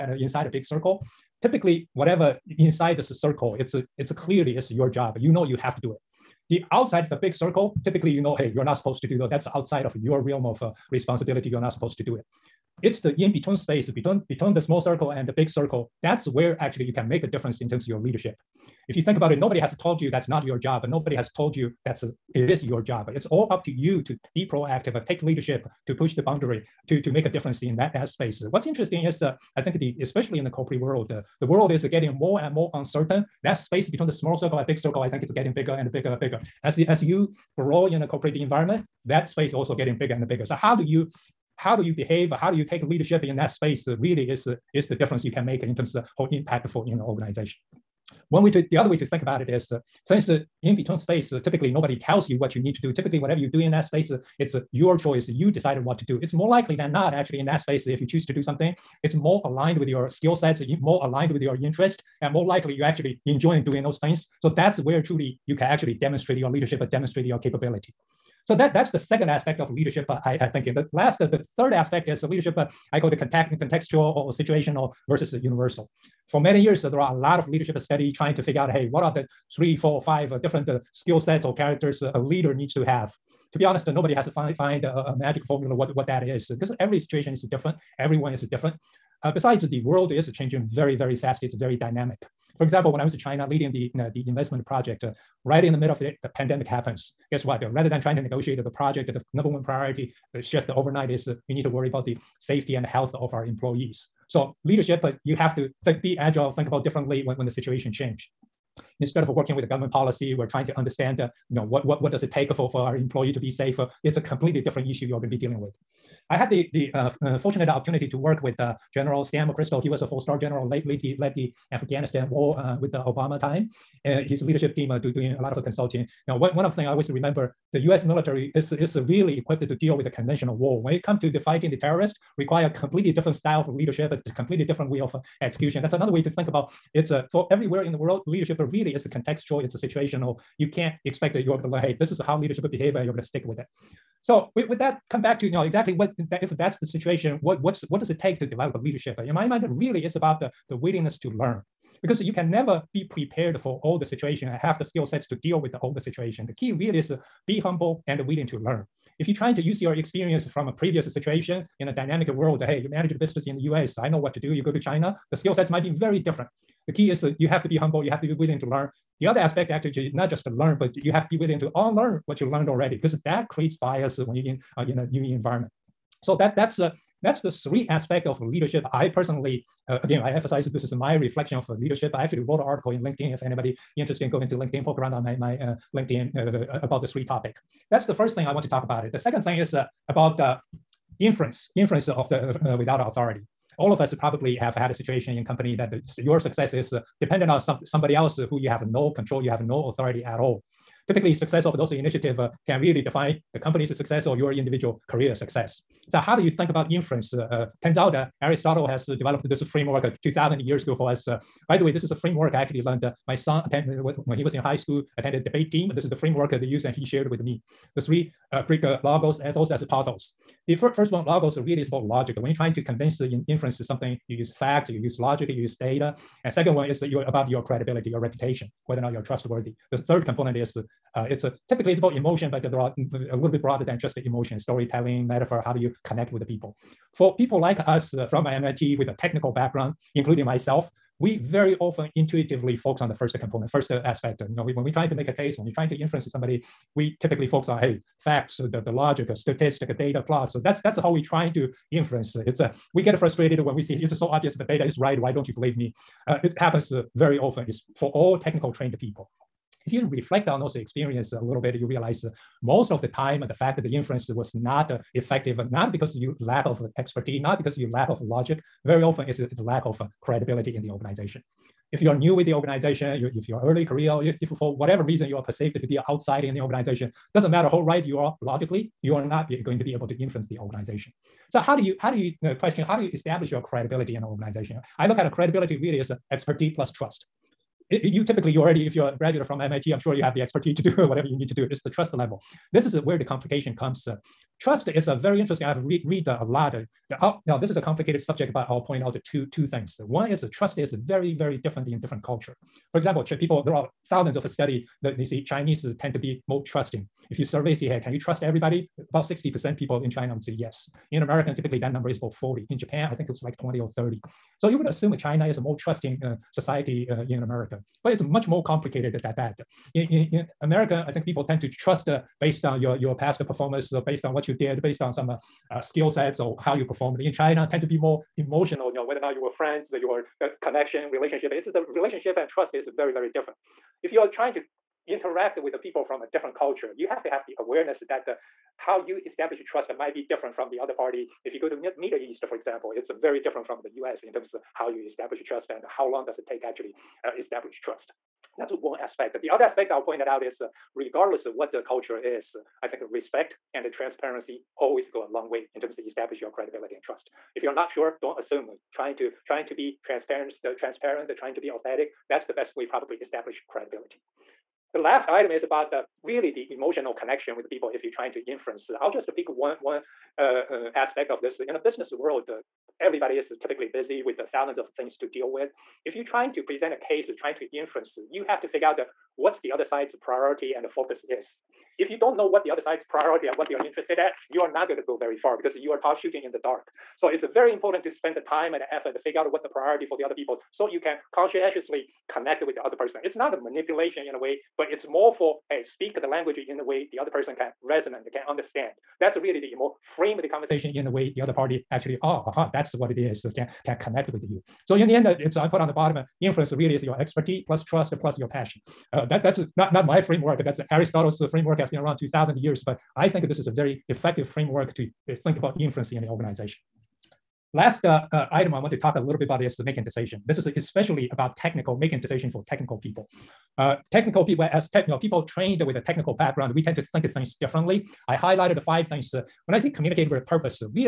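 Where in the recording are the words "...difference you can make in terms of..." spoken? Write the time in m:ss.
0:44.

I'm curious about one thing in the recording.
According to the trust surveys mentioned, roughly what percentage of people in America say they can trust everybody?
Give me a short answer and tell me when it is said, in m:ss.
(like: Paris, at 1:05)
40, at 5:12.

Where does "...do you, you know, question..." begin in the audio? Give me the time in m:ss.
4:42.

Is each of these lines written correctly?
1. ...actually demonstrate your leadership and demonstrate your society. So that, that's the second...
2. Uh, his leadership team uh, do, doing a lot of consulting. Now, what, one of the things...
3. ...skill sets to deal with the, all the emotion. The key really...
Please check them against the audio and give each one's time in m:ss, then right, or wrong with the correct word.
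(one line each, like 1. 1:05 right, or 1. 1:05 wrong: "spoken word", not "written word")
1. 1:05 wrong: "capability", not "society"
2. 2:04 right
3. 2:34 wrong: "situation", not "emotion".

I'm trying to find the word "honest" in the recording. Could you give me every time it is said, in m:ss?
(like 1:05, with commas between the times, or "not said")
1:23.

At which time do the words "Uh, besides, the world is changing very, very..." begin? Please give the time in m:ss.
1:29.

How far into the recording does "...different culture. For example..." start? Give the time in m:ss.
5:02.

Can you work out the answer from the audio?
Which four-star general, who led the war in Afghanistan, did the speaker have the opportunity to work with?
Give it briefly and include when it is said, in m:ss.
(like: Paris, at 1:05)
Stan McChrystal, at 1:58.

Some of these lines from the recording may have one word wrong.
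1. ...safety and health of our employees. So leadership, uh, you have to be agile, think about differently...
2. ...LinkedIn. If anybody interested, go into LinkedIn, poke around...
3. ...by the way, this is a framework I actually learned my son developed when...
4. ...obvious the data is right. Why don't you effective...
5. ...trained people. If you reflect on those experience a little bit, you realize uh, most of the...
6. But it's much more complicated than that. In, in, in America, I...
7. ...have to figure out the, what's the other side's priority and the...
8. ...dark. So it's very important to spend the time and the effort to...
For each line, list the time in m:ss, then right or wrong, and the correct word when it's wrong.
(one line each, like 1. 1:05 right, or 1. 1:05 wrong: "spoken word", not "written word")
1. 1:42 right
2. 3:03 right
3. 3:31 wrong: "attended", not "developed"
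4. 4:14 wrong: "believe", not "effective"
5. 4:18 right
6. 5:18 right
7. 6:18 right
8. 6:26 right.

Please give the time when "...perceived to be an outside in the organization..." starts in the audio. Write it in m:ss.
4:35.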